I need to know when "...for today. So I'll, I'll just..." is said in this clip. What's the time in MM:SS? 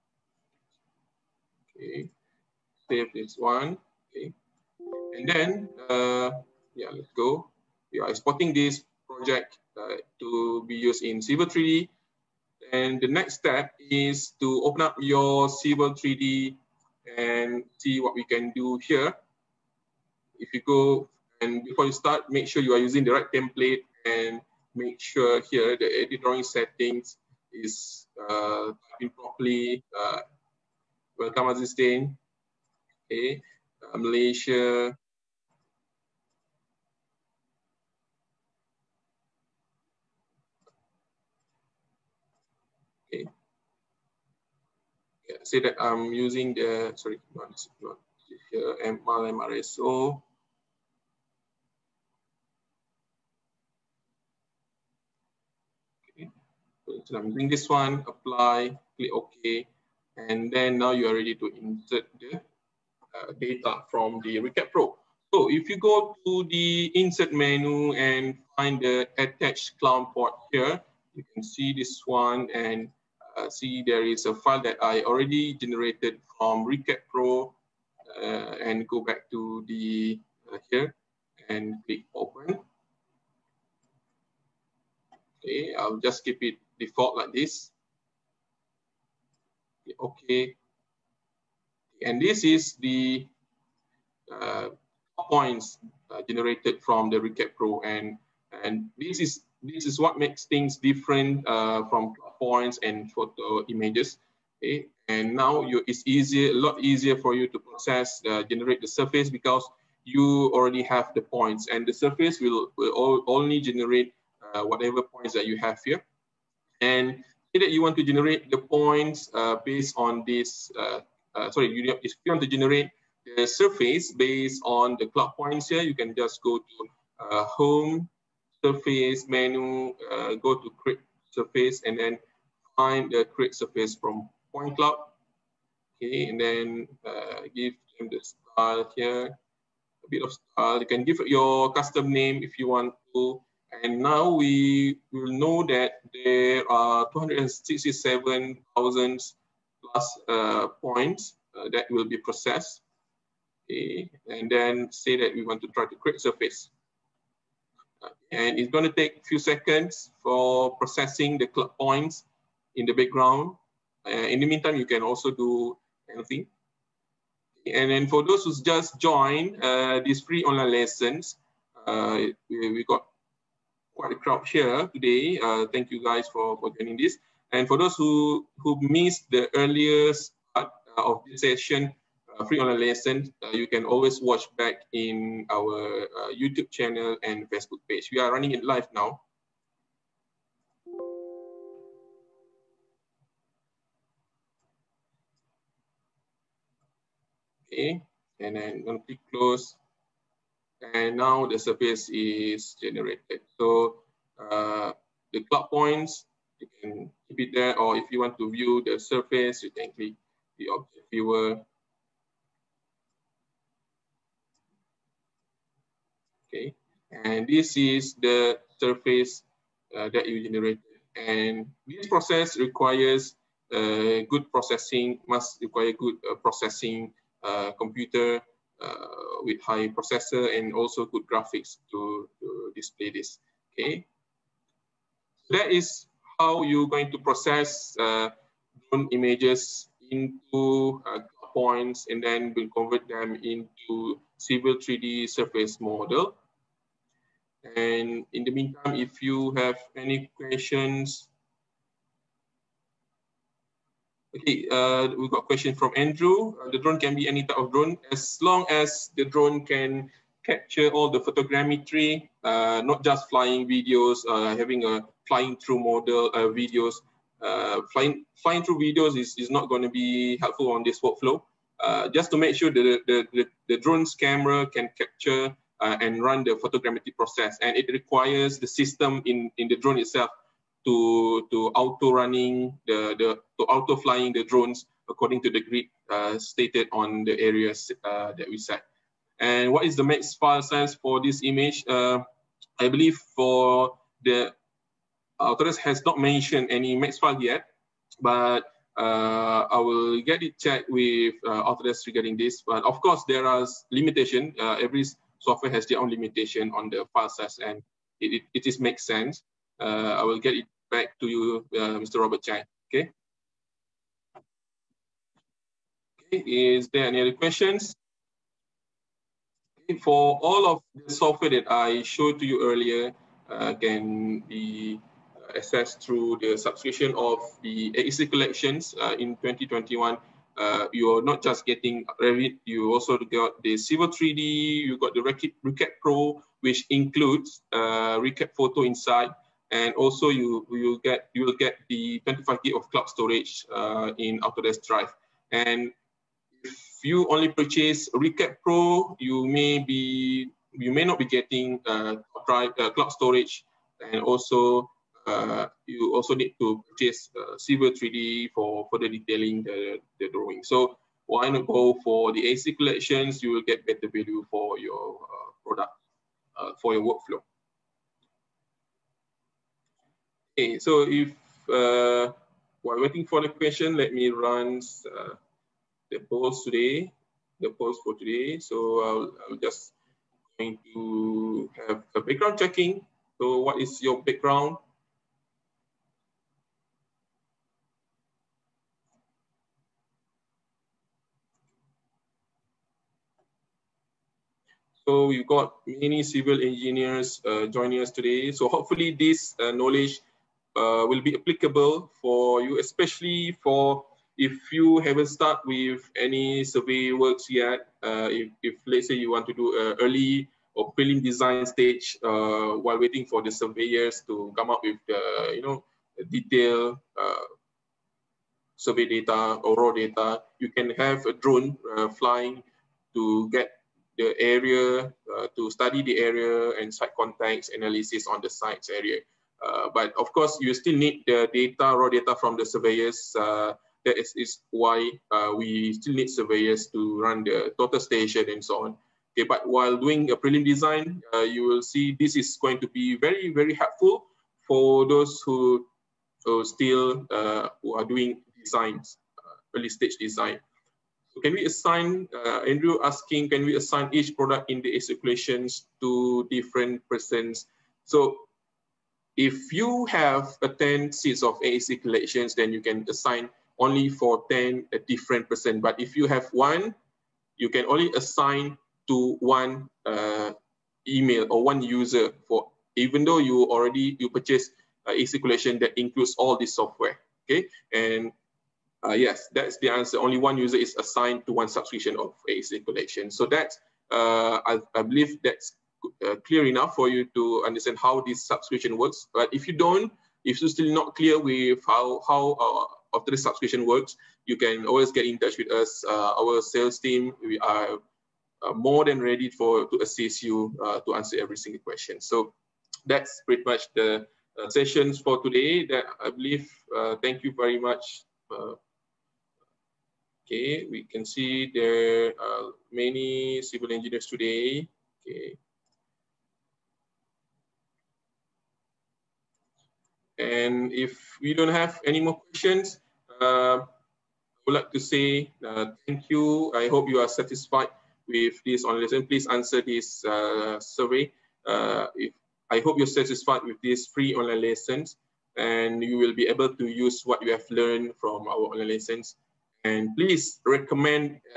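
06:18.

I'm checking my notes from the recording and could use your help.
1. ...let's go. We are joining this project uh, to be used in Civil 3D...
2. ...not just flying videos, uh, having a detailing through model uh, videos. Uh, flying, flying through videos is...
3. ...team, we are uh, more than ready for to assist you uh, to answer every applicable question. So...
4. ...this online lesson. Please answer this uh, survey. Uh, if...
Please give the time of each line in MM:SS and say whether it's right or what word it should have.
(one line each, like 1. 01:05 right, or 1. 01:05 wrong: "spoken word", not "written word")
1. 00:06 wrong: "exporting", not "joining"
2. 04:22 wrong: "flying", not "detailing"
3. 08:16 wrong: "single", not "applicable"
4. 08:48 right.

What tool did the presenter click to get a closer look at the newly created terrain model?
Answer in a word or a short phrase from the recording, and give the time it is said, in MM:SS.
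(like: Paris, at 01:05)
Object viewer, at 03:30.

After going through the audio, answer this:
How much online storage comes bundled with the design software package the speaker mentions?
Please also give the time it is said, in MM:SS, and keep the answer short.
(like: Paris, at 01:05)
25 gig, at 05:42.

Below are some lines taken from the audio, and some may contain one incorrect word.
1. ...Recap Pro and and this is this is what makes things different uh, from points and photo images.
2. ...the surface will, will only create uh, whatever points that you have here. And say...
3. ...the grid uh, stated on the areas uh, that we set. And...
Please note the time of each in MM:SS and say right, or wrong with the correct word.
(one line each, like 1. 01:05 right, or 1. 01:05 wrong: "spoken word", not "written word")
1. 01:37 right
2. 01:51 wrong: "generate", not "create"
3. 04:45 right.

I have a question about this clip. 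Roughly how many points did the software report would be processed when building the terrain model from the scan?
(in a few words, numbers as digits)
267,000.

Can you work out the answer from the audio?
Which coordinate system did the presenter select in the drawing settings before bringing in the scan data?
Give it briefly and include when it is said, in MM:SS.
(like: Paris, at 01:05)
MRSO, at 00:49.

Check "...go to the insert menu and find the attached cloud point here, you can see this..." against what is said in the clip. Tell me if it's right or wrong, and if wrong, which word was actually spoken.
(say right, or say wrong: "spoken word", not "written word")
right.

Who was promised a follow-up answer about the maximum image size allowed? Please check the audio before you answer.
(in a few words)
Robert Chang.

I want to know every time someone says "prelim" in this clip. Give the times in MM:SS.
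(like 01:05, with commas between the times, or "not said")
06:50, 07:20.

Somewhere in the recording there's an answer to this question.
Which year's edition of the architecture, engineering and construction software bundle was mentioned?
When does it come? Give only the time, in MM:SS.
05:29.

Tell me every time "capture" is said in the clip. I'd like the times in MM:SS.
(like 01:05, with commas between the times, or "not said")
04:20, 04:34.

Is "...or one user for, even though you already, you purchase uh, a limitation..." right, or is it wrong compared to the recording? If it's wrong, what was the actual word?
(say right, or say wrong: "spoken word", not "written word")
wrong: "circulation", not "limitation".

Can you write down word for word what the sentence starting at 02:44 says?
Uh, in the meantime, you can also do anything.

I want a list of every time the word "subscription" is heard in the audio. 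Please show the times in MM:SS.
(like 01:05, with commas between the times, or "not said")
05:26, 08:01, 08:08, 08:13.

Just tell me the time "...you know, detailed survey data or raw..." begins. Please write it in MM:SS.
06:55.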